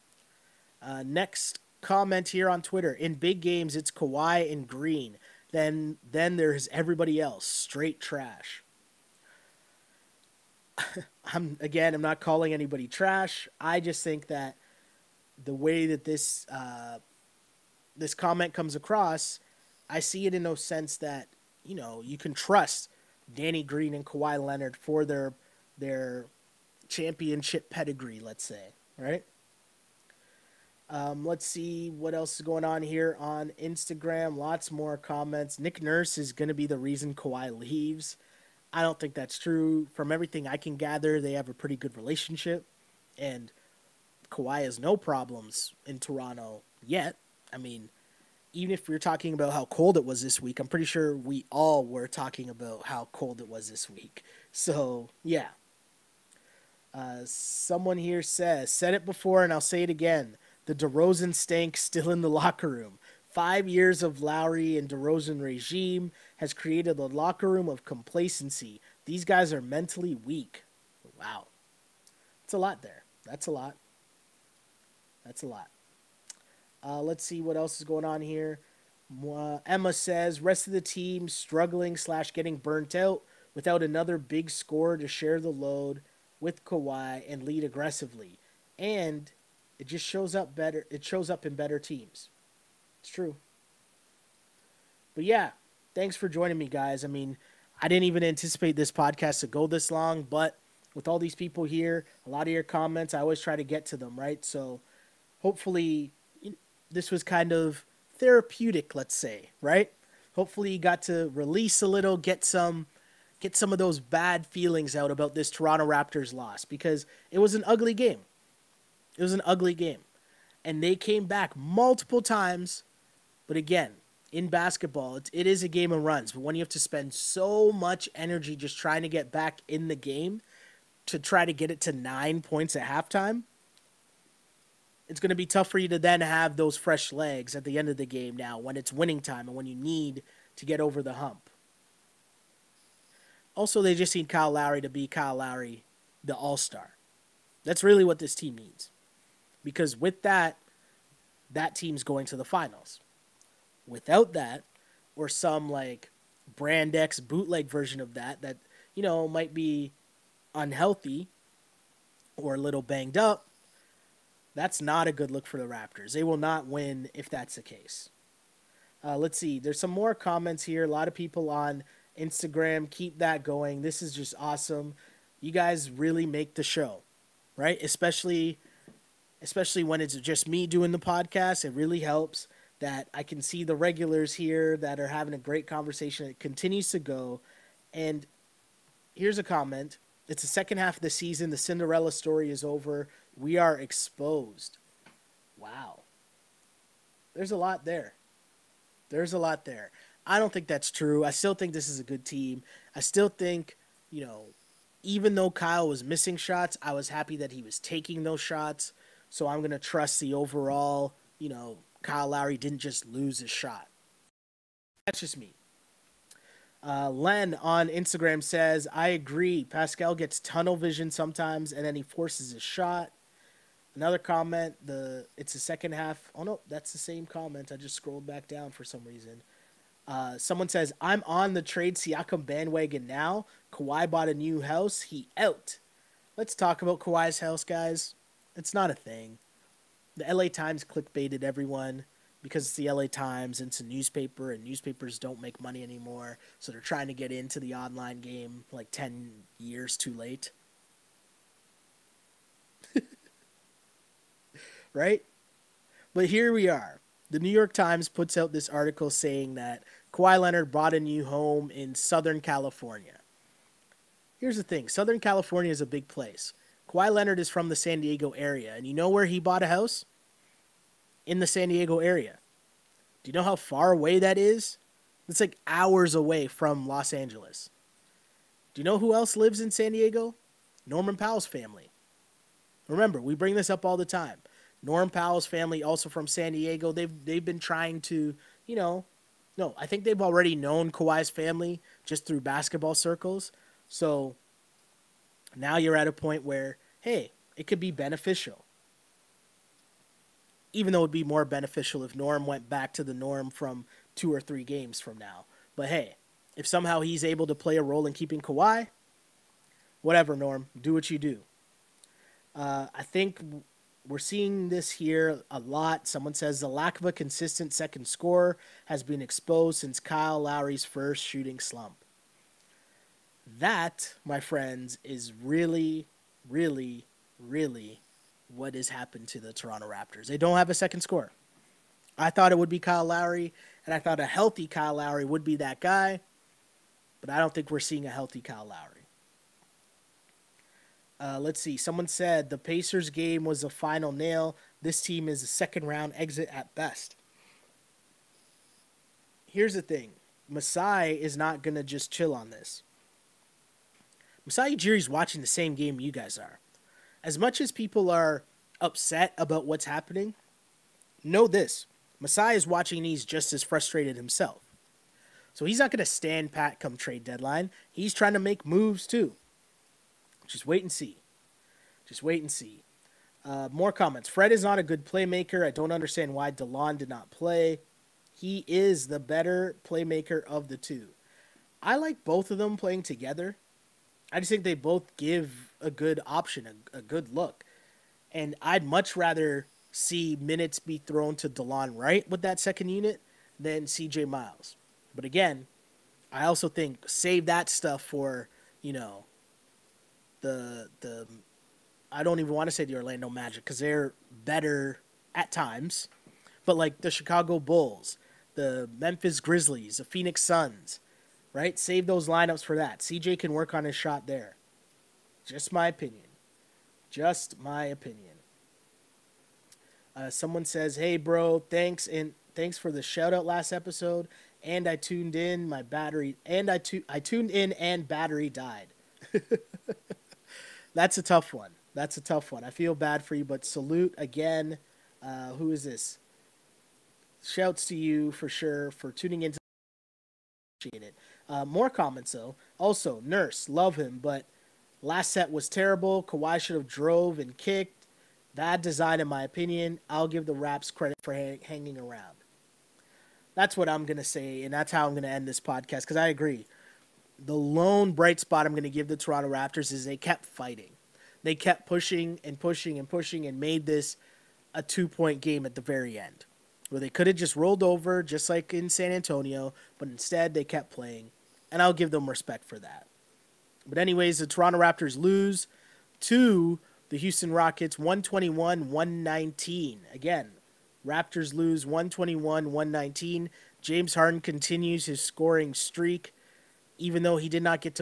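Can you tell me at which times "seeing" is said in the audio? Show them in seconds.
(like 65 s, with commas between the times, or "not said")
314 s, 337 s.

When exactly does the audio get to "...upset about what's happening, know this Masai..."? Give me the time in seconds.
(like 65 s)
358 s.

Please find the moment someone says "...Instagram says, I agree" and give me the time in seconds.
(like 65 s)
217 s.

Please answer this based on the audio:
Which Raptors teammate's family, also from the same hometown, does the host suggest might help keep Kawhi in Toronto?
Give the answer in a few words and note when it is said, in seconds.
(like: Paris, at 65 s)
Norman Powell, at 280 s.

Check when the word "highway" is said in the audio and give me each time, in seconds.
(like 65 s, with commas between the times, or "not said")
not said.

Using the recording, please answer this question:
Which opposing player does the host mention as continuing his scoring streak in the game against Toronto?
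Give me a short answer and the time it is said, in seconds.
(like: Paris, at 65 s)
James Harden, at 483 s.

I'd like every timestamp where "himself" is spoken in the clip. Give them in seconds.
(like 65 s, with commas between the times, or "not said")
364 s.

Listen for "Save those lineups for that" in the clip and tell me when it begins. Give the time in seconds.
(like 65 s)
411 s.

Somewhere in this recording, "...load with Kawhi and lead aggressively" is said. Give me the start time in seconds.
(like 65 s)
85 s.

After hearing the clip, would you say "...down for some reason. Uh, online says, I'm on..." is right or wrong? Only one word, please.
wrong.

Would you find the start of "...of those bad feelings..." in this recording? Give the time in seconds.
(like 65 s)
113 s.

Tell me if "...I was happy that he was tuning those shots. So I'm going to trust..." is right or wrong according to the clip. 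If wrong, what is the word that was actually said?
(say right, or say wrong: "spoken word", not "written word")
wrong: "taking", not "tuning".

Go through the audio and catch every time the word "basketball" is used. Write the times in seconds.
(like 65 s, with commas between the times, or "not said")
124 s, 292 s.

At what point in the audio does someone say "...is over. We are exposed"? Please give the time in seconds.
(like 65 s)
192 s.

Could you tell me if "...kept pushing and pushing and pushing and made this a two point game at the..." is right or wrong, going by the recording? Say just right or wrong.
right.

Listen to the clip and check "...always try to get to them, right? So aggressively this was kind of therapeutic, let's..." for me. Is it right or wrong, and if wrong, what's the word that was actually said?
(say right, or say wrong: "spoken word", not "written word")
wrong: "hopefully", not "aggressively".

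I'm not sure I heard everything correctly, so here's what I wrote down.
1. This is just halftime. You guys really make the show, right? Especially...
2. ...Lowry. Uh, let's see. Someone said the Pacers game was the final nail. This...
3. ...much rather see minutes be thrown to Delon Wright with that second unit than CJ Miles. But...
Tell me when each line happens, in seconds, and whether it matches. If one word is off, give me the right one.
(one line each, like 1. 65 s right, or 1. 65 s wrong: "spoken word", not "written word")
1. 173 s wrong: "awesome", not "halftime"
2. 338 s right
3. 388 s right.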